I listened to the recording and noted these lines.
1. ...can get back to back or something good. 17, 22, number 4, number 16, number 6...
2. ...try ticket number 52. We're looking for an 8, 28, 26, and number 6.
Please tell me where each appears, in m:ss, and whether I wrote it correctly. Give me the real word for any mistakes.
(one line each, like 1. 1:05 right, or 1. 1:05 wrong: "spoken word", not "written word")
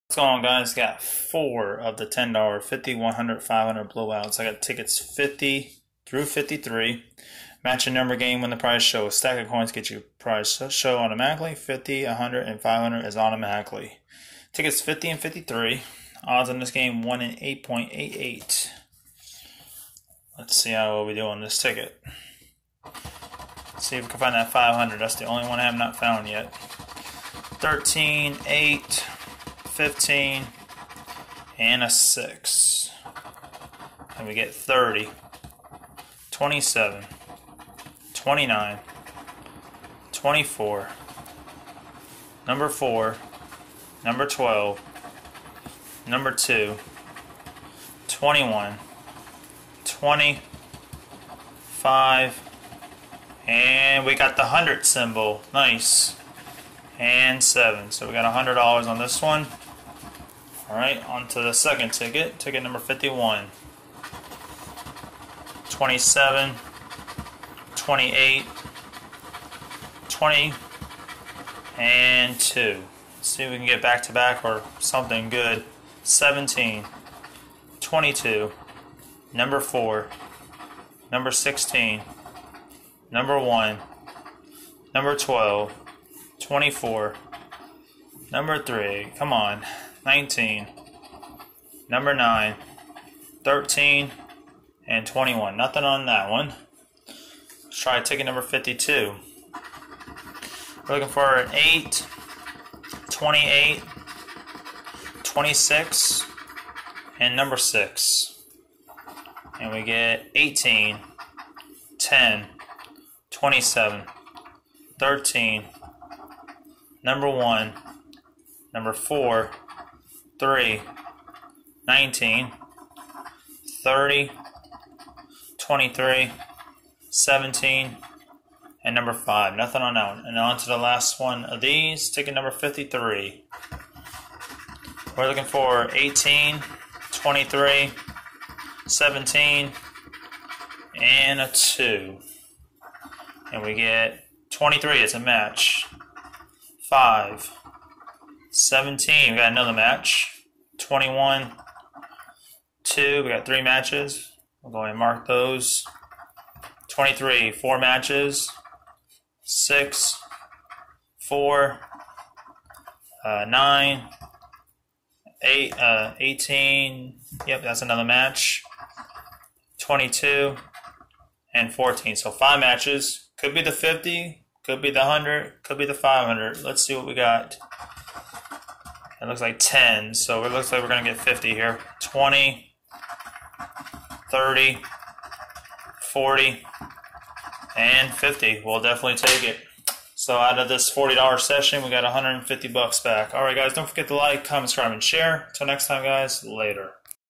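1. 1:13 wrong: "1", not "6"
2. 1:37 right.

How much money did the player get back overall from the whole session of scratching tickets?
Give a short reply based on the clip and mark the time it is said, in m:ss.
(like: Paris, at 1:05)
$150, at 3:12.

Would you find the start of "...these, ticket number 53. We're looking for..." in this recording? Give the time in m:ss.
2:11.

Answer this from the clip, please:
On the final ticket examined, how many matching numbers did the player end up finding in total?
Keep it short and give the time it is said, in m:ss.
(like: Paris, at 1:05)
5, at 2:52.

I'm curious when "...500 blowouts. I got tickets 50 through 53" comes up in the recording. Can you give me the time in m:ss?
0:03.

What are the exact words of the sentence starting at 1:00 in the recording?
Alright, on to the second ticket, ticket number 51.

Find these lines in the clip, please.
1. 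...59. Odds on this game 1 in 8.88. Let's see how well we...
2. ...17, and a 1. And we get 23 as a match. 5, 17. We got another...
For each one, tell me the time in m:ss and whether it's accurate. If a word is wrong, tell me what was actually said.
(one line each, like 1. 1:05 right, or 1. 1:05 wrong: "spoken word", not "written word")
1. 0:15 wrong: "53", not "59"
2. 2:18 wrong: "2", not "1".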